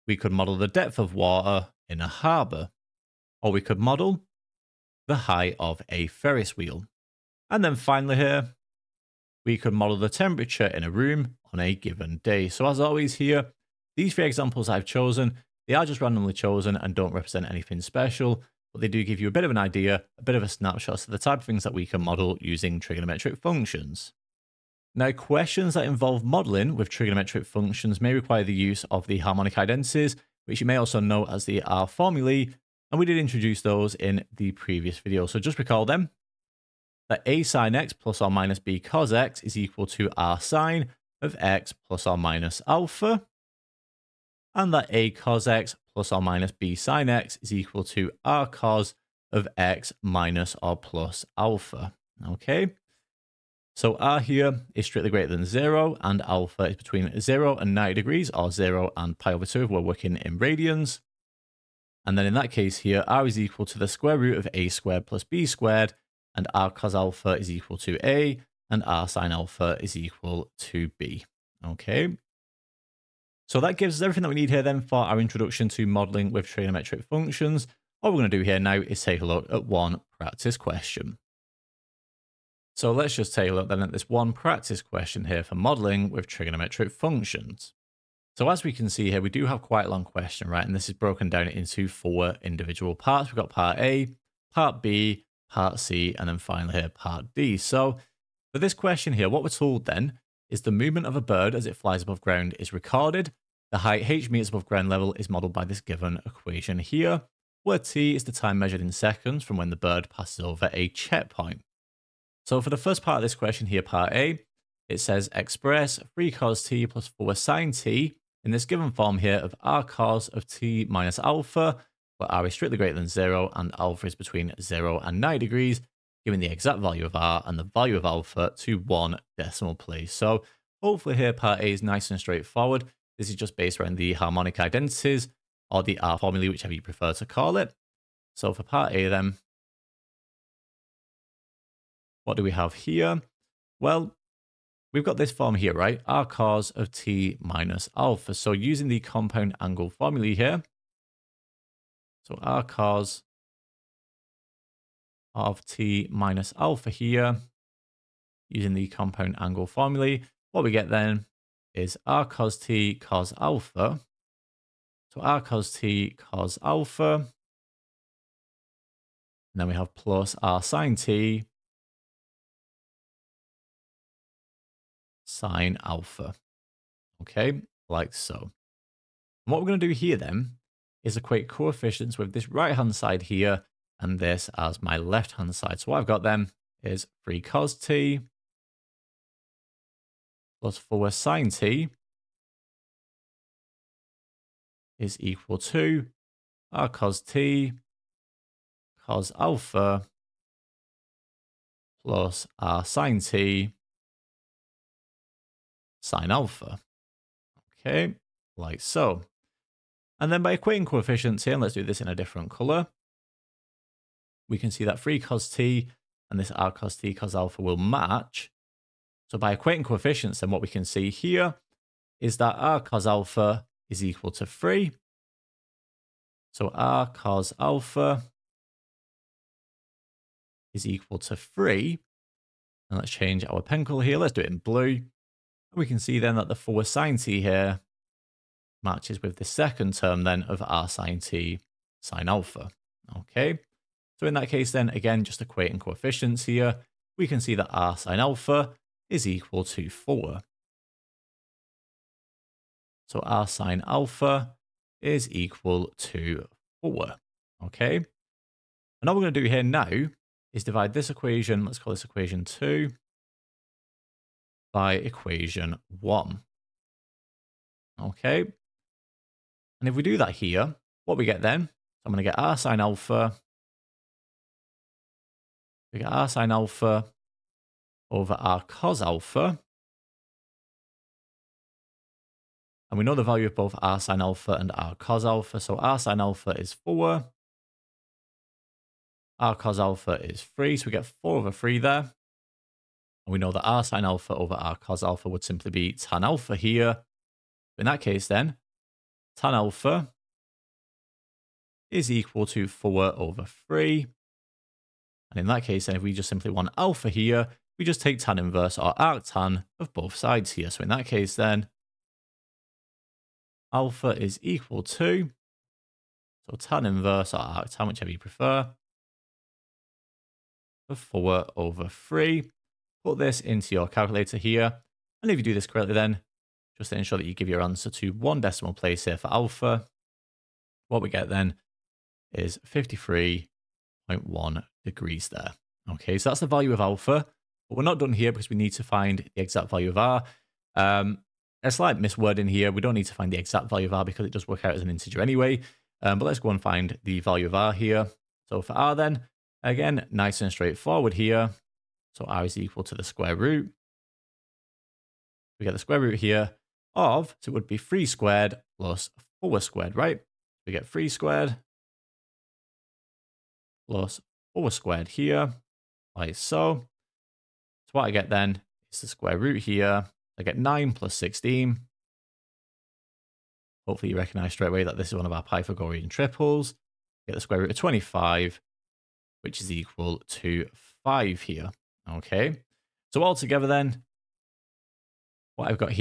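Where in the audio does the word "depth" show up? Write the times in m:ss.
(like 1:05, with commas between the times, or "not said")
0:00.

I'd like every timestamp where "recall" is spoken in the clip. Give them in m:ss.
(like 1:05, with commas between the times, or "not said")
0:35.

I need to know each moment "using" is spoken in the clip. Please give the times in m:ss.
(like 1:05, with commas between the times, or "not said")
0:22, 2:28, 2:38.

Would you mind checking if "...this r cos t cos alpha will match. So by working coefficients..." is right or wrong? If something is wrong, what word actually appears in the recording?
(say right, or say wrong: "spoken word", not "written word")
wrong: "equating", not "working".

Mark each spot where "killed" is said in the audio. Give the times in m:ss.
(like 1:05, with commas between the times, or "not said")
not said.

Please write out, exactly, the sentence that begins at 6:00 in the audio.
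We get 3 squared plus 4 squared here, like so.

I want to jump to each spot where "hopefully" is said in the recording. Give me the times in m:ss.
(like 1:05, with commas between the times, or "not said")
2:10, 6:13.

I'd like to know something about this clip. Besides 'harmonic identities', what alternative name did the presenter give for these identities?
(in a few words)
R formulae.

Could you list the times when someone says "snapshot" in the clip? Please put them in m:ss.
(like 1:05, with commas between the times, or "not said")
0:20.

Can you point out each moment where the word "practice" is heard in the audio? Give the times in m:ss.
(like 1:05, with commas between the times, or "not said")
1:20, 1:24.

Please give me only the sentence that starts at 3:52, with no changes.
And let's change our pencil here.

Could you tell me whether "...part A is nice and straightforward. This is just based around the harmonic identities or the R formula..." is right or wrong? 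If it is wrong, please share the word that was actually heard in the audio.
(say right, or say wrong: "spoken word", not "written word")
right.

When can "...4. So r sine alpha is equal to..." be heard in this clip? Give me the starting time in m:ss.
4:09.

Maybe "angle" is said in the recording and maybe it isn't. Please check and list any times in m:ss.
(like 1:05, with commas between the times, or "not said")
2:29, 2:39.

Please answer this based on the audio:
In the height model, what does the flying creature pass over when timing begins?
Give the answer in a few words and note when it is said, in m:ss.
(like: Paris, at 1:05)
a checkpoint, at 1:50.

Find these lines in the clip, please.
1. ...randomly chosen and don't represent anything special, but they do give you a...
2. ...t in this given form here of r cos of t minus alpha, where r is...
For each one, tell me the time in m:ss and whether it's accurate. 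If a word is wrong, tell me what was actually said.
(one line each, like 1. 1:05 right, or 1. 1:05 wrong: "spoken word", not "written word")
1. 0:16 right
2. 1:57 right.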